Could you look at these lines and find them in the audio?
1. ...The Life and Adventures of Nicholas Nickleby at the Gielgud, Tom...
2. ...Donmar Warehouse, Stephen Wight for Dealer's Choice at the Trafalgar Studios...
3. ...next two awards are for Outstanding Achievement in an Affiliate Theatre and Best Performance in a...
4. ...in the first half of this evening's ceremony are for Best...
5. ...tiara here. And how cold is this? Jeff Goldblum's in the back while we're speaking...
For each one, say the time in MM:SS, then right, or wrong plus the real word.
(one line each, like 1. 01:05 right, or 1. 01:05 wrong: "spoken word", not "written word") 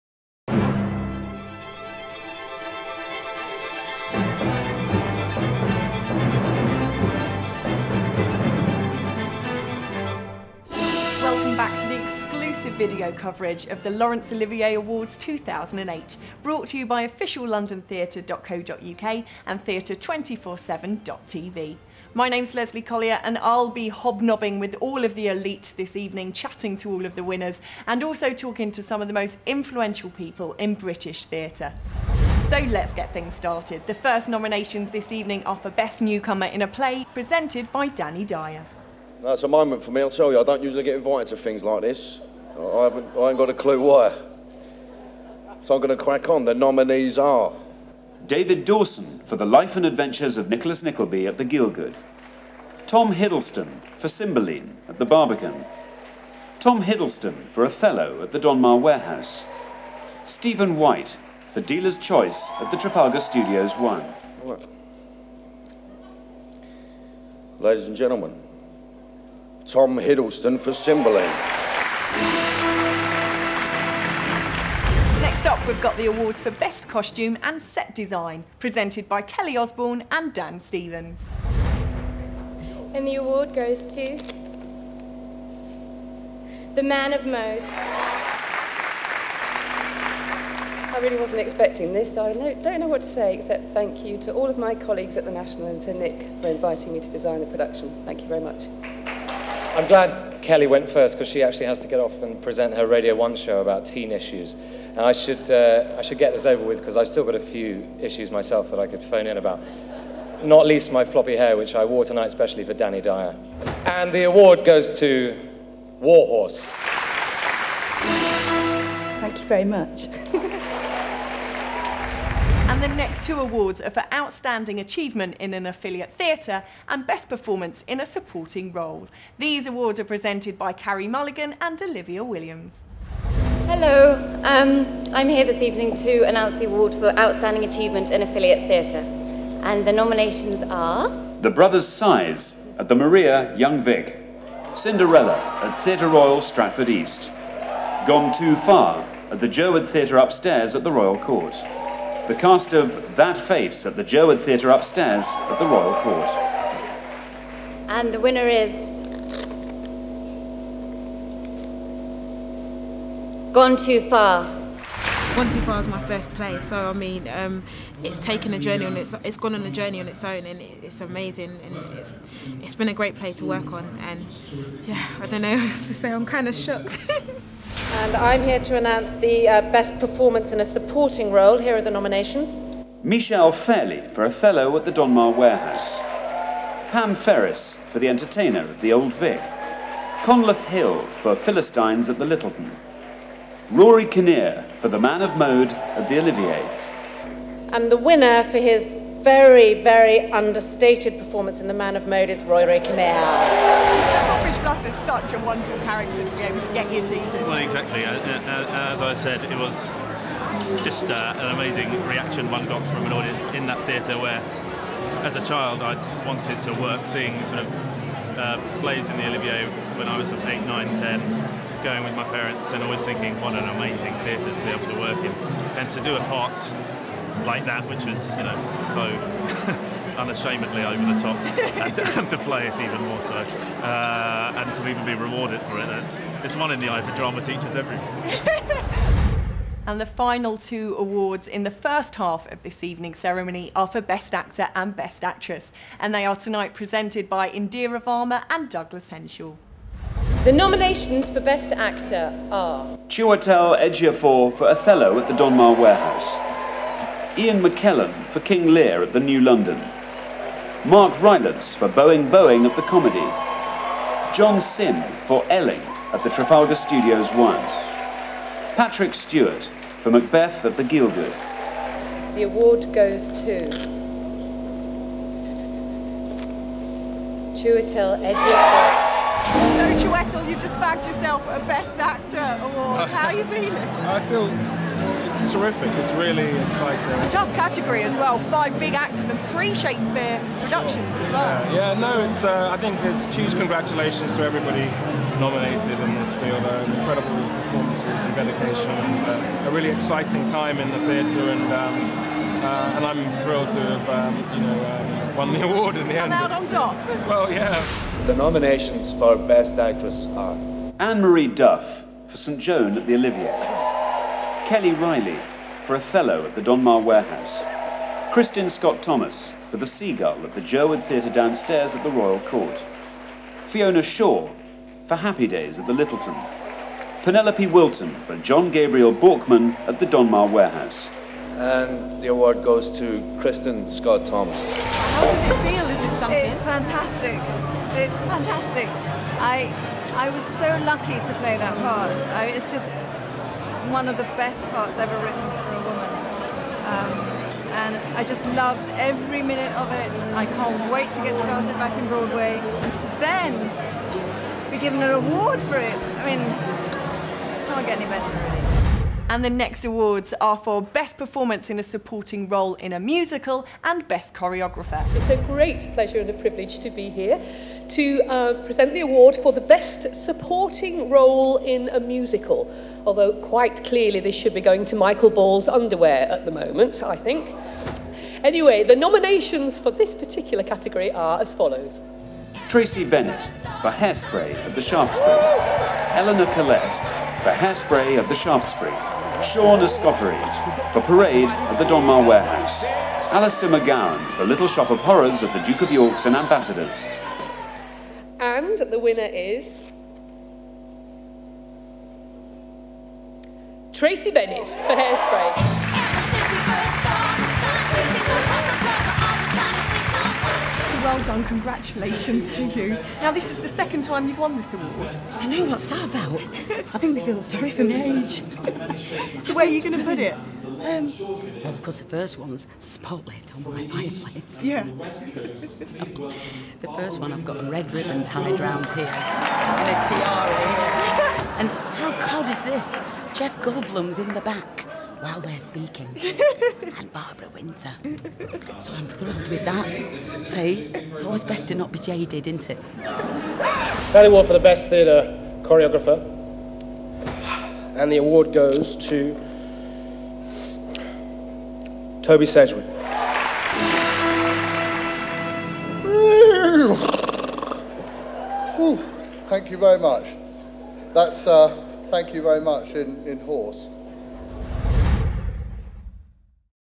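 1. 00:49 right
2. 00:58 right
3. 02:02 right
4. 04:01 right
5. 07:10 right.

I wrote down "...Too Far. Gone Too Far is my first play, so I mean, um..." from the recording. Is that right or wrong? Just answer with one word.
right.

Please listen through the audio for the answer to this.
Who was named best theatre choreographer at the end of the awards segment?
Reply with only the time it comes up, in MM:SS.
07:28.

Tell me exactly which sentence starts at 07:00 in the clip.
Um, well, the first one's spotlight on my fireplace.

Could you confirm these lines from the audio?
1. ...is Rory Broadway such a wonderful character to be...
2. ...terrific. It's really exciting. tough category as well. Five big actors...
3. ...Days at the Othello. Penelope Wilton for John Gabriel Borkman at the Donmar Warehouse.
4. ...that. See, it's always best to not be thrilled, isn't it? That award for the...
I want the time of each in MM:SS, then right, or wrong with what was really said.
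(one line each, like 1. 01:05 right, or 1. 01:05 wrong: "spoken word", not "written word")
1. 03:22 wrong: "Kinnear", not "Broadway"
2. 04:45 right
3. 05:25 wrong: "Lyttelton", not "Othello"
4. 07:19 wrong: "jaded", not "thrilled".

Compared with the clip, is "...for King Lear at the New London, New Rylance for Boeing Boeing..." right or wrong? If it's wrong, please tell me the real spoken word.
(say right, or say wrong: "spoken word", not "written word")
wrong: "Mark", not "New".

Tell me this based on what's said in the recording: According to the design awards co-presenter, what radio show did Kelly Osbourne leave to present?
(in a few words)
Radio 1 show about teen issues.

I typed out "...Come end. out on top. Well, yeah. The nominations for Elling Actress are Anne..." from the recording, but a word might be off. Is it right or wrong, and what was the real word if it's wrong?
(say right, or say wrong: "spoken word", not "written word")
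wrong: "Best", not "Elling".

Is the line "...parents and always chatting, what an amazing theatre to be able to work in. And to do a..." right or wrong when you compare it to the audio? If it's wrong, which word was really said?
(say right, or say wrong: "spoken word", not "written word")
wrong: "thinking", not "chatting".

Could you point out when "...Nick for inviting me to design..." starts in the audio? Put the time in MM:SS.
01:35.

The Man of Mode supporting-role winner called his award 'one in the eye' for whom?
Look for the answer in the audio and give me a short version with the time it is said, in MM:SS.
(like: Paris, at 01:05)
drama teachers, at 03:56.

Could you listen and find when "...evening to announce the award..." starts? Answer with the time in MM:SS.
02:15.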